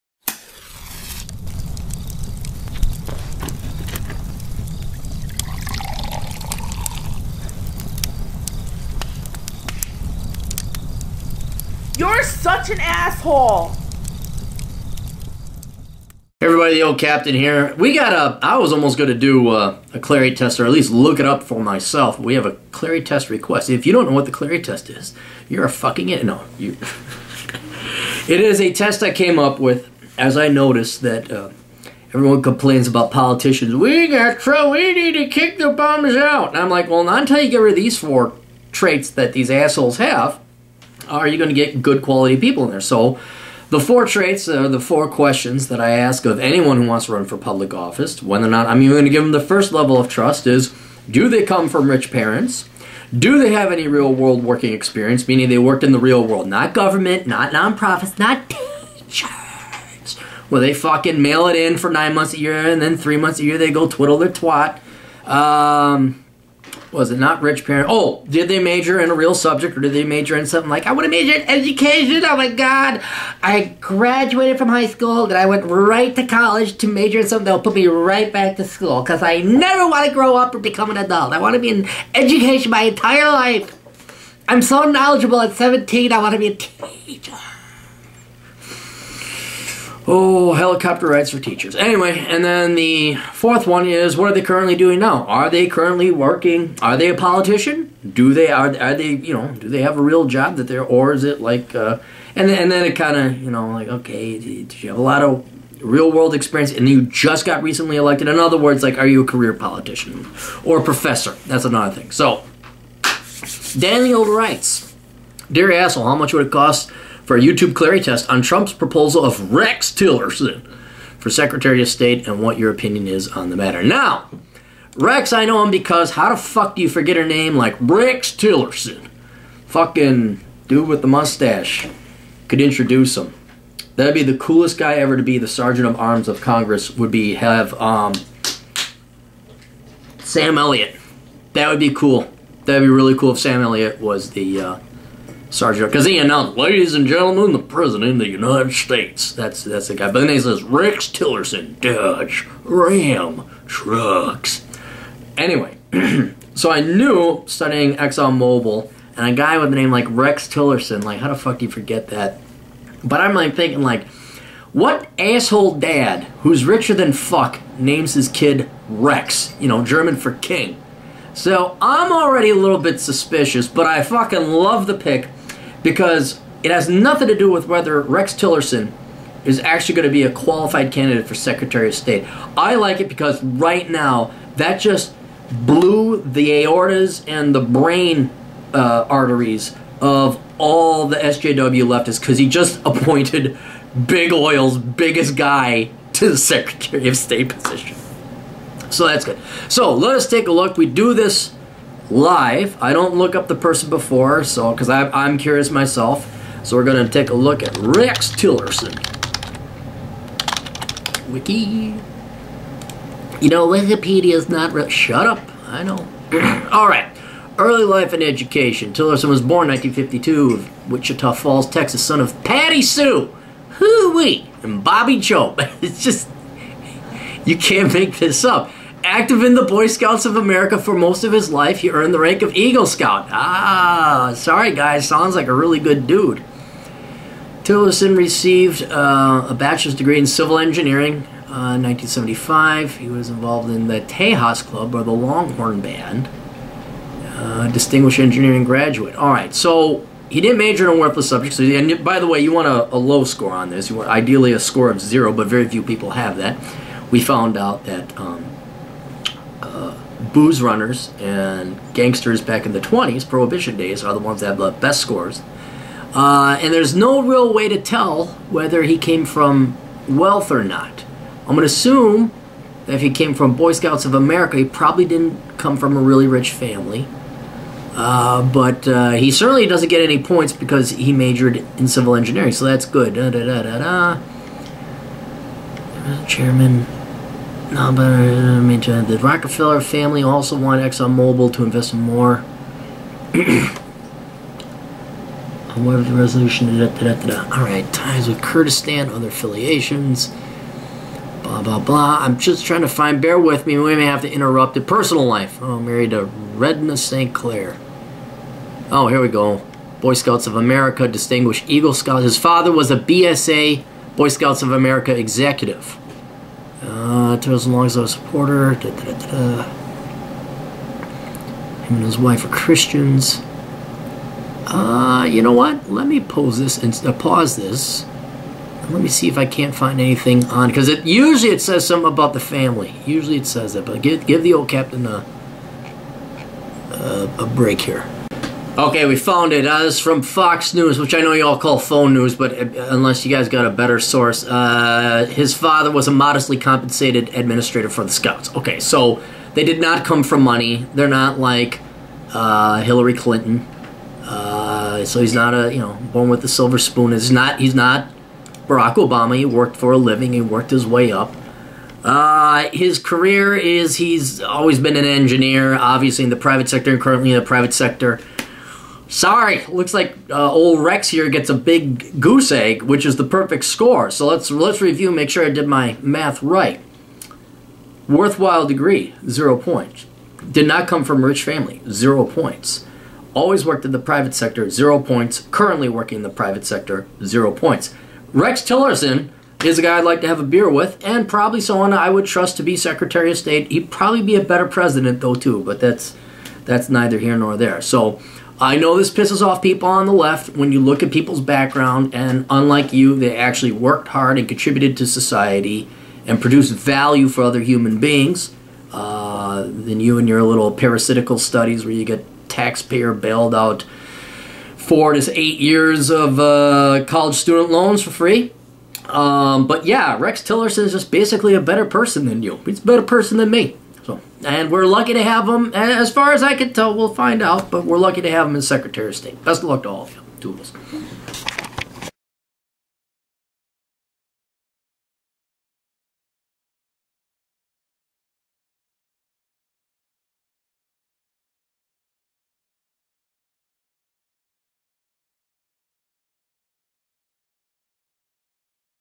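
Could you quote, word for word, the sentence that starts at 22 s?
We have a Clarey test request.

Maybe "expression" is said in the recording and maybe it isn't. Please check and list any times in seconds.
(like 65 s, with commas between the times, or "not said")
not said.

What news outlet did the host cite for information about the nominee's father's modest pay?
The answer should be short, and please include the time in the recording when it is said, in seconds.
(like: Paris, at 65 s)
Fox News, at 340 s.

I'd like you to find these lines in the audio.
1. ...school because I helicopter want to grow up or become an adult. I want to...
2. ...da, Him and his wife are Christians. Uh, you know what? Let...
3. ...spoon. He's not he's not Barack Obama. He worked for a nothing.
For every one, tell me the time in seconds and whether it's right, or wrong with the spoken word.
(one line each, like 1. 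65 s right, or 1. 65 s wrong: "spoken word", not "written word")
1. 78 s wrong: "never", not "helicopter"
2. 319 s right
3. 356 s wrong: "living", not "nothing".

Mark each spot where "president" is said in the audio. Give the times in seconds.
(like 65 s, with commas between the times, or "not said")
147 s, 394 s.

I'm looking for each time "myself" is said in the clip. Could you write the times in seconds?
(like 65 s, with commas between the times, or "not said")
21 s, 205 s.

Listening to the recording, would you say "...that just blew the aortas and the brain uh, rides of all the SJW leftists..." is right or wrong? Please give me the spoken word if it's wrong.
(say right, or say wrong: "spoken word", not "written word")
wrong: "arteries", not "rides".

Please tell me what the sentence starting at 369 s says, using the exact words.
Sorry, looks like uh, old Rex here gets a big goose egg, which is the perfect score.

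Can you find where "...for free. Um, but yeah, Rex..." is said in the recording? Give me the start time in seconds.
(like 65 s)
418 s.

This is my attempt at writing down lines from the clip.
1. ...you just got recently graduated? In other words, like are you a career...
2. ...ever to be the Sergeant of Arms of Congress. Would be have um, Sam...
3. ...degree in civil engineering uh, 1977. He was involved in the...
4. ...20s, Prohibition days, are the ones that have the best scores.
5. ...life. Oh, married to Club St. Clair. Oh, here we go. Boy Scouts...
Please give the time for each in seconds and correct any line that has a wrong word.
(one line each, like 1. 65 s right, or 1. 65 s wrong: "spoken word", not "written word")
1. 106 s wrong: "elected", not "graduated"
2. 134 s right
3. 239 s wrong: "1975", not "1977"
4. 262 s right
5. 305 s wrong: "Redna", not "Club".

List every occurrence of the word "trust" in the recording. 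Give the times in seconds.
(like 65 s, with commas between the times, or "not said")
50 s, 392 s.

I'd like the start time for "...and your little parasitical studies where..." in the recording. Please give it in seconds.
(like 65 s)
410 s.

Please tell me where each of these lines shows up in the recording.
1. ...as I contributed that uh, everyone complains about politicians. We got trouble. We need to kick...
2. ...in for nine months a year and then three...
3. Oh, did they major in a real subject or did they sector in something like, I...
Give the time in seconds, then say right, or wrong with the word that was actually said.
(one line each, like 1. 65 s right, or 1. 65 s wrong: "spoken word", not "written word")
1. 30 s wrong: "noticed", not "contributed"
2. 61 s right
3. 67 s wrong: "major", not "sector".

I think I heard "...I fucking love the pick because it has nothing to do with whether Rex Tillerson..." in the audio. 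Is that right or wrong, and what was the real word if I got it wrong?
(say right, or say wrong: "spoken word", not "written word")
right.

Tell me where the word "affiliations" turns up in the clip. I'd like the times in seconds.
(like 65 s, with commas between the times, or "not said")
299 s.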